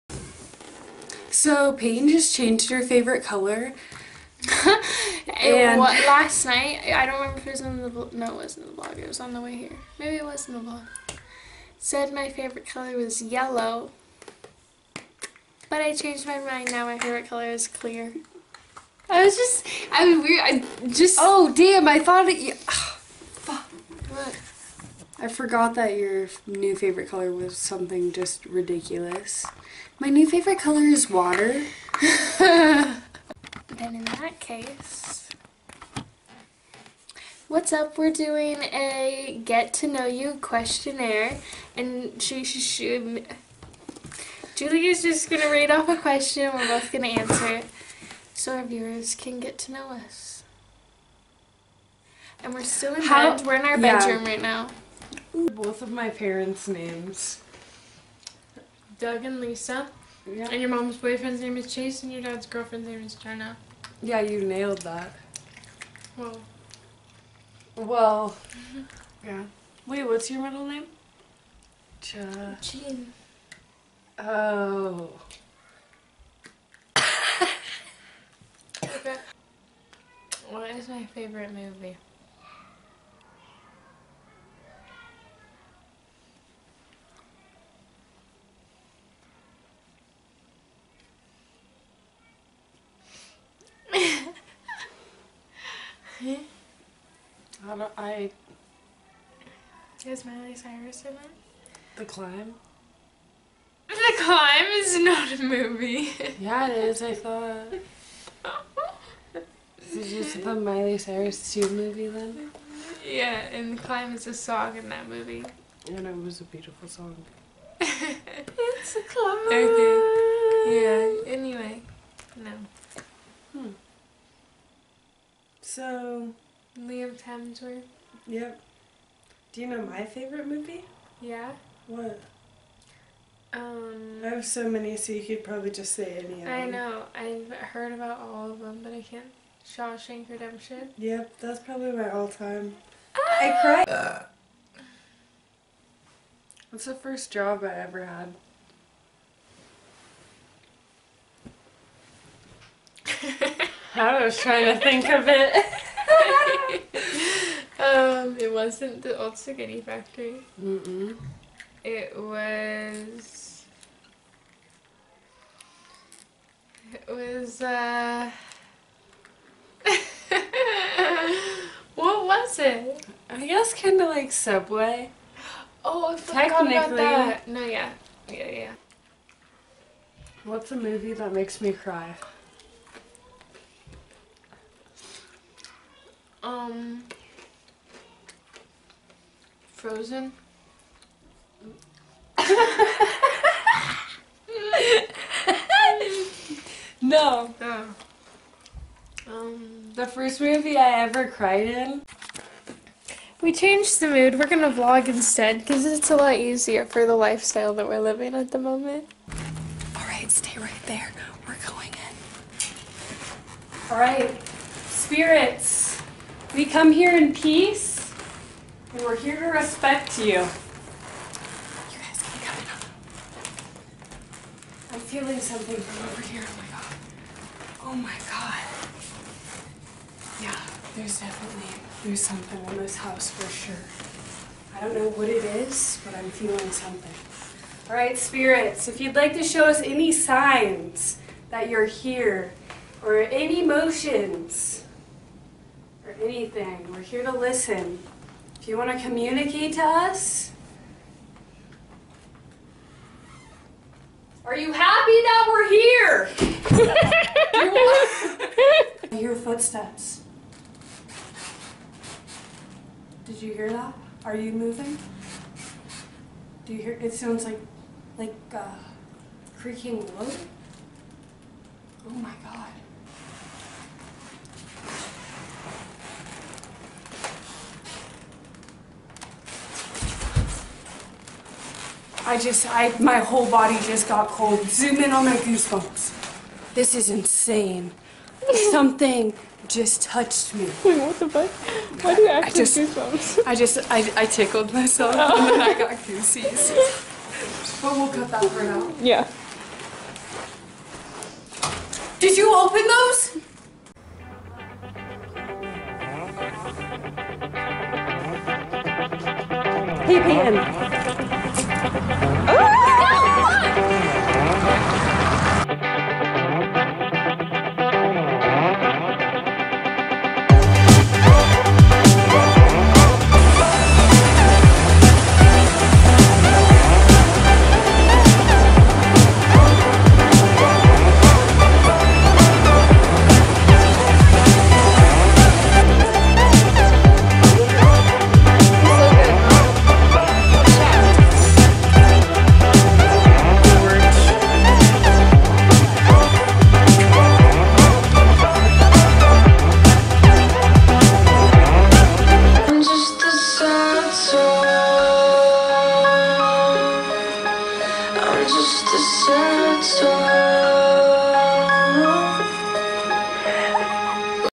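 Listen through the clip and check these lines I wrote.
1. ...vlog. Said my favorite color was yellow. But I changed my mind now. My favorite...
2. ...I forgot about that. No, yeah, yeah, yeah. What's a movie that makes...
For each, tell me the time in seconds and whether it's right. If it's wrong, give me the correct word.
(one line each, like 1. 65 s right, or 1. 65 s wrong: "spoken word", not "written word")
1. 10 s right
2. 176 s right.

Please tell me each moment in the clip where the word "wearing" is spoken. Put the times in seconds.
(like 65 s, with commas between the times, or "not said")
not said.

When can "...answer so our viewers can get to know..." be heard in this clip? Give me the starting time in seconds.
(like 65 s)
47 s.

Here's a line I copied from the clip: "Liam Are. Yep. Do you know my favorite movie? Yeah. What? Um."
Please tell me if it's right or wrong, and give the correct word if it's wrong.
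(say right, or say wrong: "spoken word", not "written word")
wrong: "Hemsworth", not "Are".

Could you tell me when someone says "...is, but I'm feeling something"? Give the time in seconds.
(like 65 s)
235 s.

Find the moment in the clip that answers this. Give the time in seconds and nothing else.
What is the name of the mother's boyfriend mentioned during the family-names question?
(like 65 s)
61 s.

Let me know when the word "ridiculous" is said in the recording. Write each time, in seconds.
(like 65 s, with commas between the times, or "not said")
28 s.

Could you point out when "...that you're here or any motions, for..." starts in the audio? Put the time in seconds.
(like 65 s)
241 s.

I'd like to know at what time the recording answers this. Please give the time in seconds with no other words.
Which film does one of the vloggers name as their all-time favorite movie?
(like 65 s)
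139 s.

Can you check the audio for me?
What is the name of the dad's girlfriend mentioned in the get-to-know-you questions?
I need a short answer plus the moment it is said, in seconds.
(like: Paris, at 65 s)
Jenna, at 63 s.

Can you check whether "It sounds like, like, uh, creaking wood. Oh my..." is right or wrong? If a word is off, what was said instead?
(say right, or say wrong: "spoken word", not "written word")
right.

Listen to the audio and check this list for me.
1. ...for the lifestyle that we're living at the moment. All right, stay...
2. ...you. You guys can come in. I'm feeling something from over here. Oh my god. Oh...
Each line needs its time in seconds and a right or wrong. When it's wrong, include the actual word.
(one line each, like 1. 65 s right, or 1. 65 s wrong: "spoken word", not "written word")
1. 206 s right
2. 220 s right.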